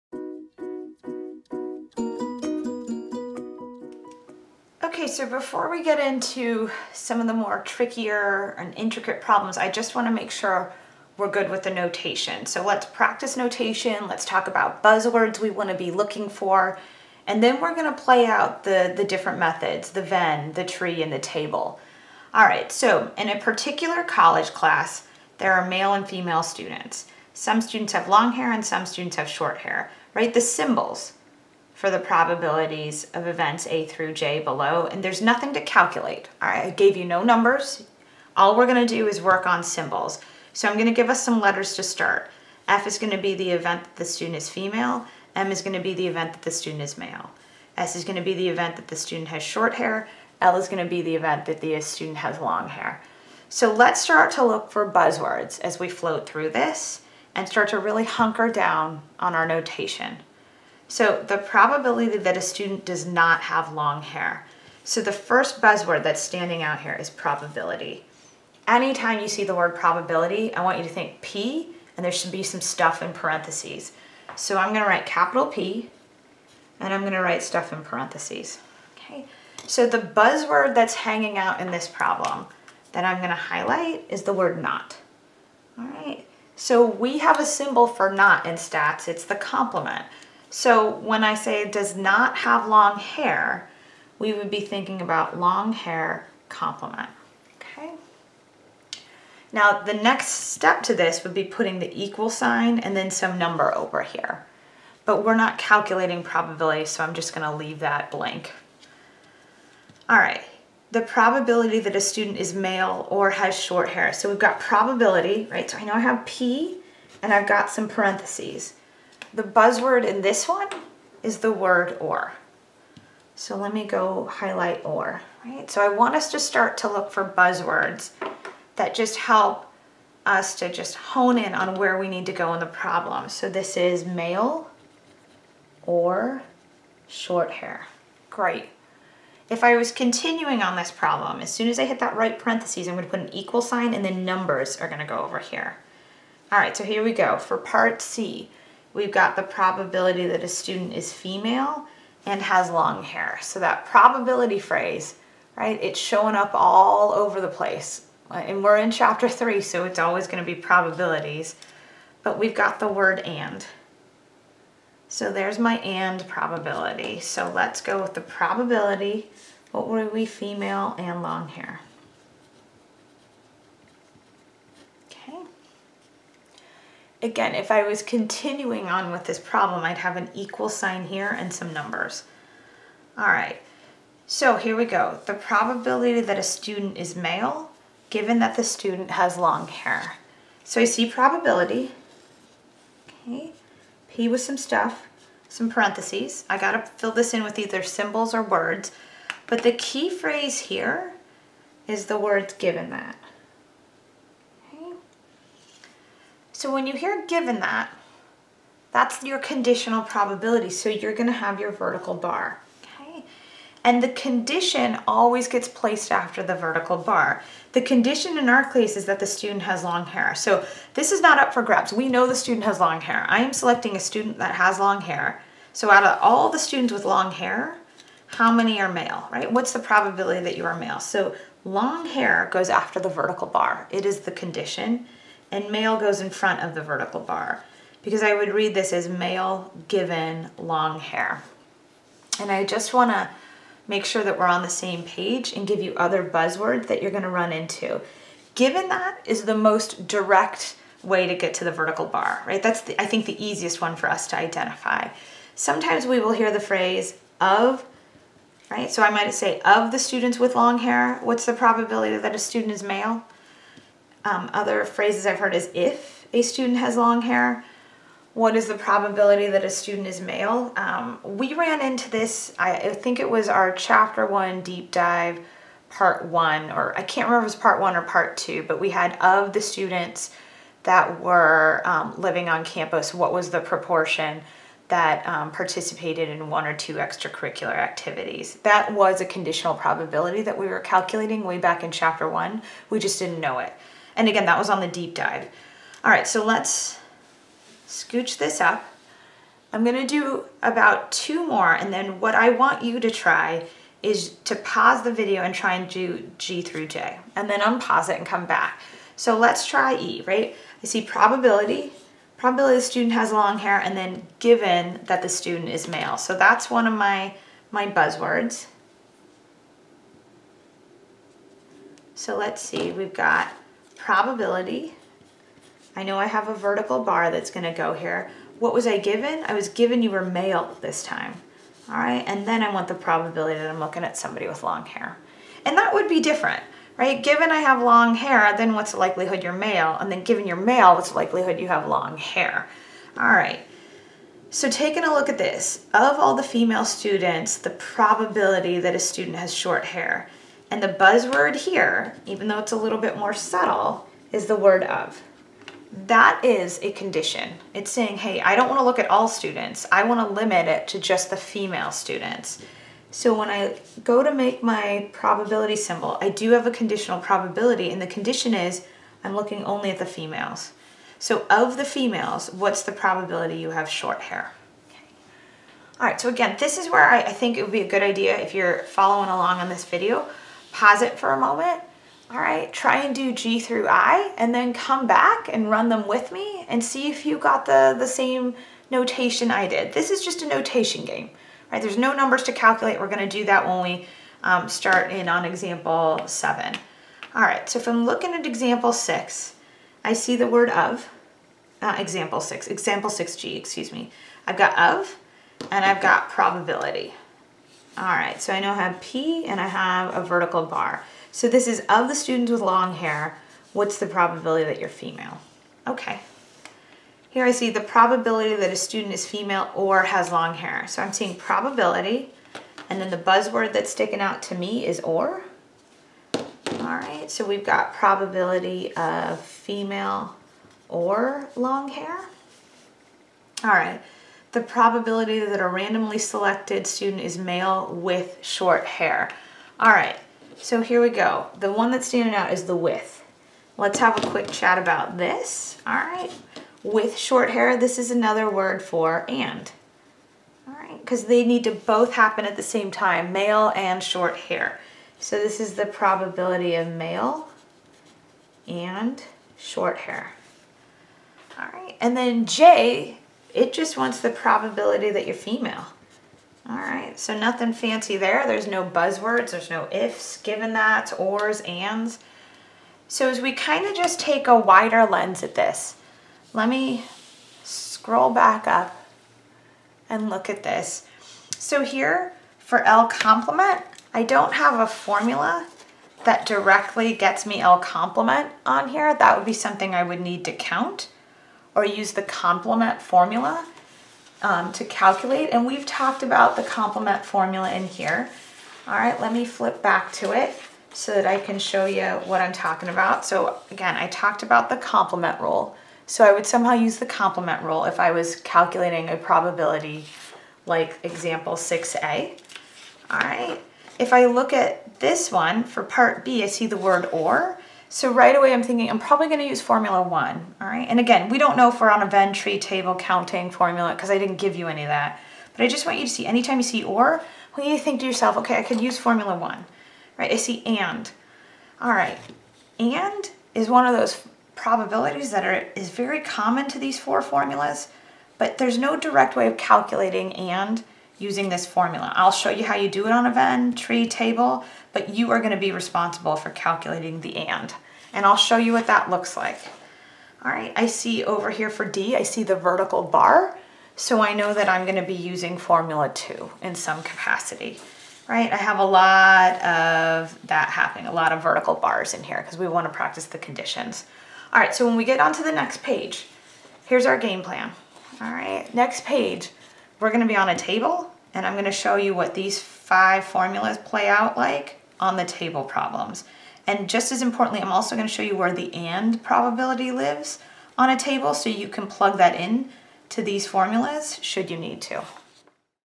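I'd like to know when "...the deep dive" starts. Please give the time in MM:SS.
04:54.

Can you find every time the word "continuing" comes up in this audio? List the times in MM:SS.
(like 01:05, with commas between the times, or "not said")
02:19, 02:58.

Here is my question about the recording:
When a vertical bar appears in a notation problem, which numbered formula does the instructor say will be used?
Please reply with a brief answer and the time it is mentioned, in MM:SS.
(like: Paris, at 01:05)
formula two, at 09:15.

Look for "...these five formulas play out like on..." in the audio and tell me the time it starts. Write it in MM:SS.
09:32.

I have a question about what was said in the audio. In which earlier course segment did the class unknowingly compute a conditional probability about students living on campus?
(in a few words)
chapter one deep dive.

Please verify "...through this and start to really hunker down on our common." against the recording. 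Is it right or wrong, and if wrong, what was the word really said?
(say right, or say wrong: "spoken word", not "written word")
wrong: "notation", not "common".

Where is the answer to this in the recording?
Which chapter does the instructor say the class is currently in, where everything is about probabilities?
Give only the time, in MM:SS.
02:38.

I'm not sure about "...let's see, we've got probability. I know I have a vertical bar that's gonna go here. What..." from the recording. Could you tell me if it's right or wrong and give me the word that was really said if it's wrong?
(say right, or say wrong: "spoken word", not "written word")
right.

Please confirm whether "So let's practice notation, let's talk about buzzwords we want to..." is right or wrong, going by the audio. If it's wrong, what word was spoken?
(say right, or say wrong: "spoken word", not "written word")
right.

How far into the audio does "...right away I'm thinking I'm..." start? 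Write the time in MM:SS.
08:38.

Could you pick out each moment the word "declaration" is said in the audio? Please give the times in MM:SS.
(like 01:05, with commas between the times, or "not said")
not said.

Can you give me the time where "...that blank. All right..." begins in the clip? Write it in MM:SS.
01:47.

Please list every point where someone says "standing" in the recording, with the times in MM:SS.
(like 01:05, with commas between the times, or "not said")
01:06, 07:22.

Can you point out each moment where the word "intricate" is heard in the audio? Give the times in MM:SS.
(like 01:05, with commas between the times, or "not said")
00:08.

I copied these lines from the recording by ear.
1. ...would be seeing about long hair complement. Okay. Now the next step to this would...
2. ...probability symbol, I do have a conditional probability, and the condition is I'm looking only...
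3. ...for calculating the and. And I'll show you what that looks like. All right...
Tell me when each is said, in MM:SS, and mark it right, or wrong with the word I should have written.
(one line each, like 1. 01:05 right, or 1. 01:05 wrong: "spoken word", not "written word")
1. 01:34 wrong: "thinking", not "seeing"
2. 06:05 right
3. 09:06 right.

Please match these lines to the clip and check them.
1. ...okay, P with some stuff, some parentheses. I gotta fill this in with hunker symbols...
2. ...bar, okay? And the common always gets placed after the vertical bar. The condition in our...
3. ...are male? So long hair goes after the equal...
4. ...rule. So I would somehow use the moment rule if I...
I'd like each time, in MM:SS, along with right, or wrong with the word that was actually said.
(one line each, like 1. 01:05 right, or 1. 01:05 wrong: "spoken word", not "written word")
1. 03:13 wrong: "either", not "hunker"
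2. 03:32 wrong: "condition", not "common"
3. 03:50 wrong: "vertical", not "equal"
4. 08:25 wrong: "complement", not "moment".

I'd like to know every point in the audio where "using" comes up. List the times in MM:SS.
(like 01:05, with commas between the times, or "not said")
09:01, 09:15.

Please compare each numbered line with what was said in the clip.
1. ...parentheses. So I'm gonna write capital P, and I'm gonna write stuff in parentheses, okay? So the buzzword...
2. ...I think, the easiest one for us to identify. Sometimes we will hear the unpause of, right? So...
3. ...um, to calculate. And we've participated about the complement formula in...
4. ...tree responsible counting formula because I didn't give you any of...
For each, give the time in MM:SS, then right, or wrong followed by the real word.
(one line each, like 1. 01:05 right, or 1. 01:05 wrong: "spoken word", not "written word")
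1. 01:13 right
2. 04:12 wrong: "phrase", not "unpause"
3. 08:14 wrong: "talked", not "participated"
4. 08:42 wrong: "table", not "responsible".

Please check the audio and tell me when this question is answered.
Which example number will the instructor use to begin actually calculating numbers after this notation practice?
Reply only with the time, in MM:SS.
06:35.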